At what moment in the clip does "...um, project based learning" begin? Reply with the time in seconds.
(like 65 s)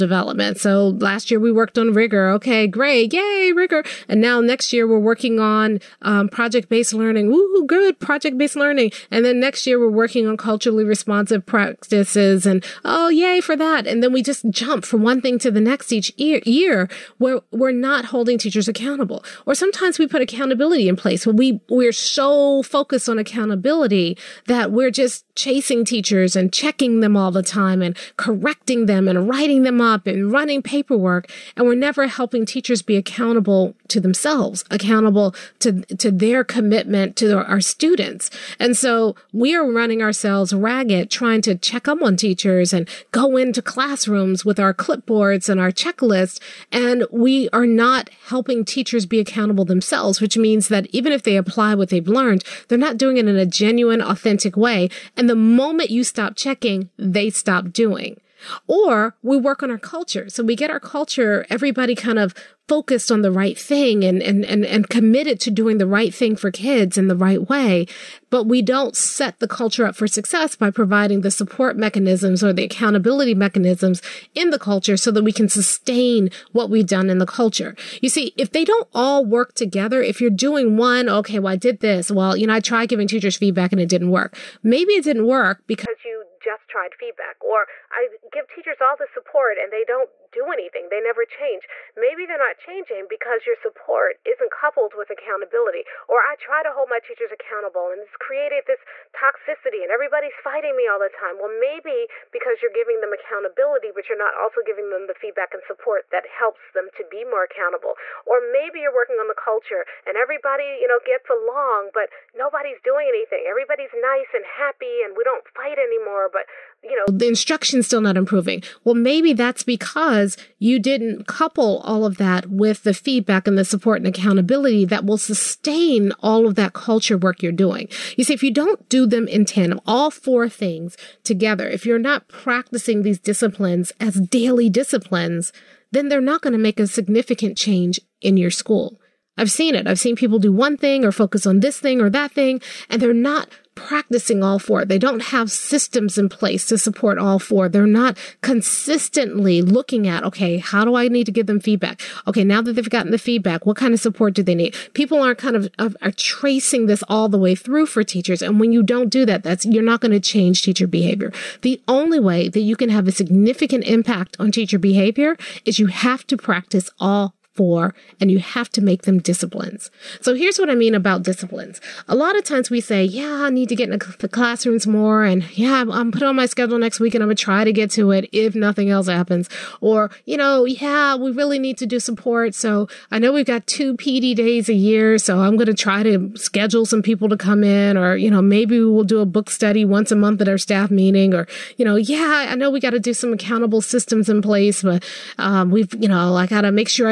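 6 s.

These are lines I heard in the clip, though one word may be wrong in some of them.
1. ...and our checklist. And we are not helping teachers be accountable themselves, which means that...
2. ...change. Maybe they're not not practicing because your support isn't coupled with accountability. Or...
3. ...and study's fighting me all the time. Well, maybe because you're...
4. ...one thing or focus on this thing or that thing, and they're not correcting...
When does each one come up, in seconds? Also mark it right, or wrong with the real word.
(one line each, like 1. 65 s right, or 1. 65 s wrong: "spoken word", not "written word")
1. 45 s right
2. 91 s wrong: "changing", not "practicing"
3. 99 s wrong: "everybody", not "study"
4. 140 s wrong: "practicing", not "correcting".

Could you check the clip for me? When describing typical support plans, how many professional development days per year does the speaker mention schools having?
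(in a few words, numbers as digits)
2.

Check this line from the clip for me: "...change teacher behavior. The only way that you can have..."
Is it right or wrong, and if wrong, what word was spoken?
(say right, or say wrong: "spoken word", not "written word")
right.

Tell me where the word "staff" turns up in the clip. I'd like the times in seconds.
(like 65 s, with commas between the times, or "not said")
190 s.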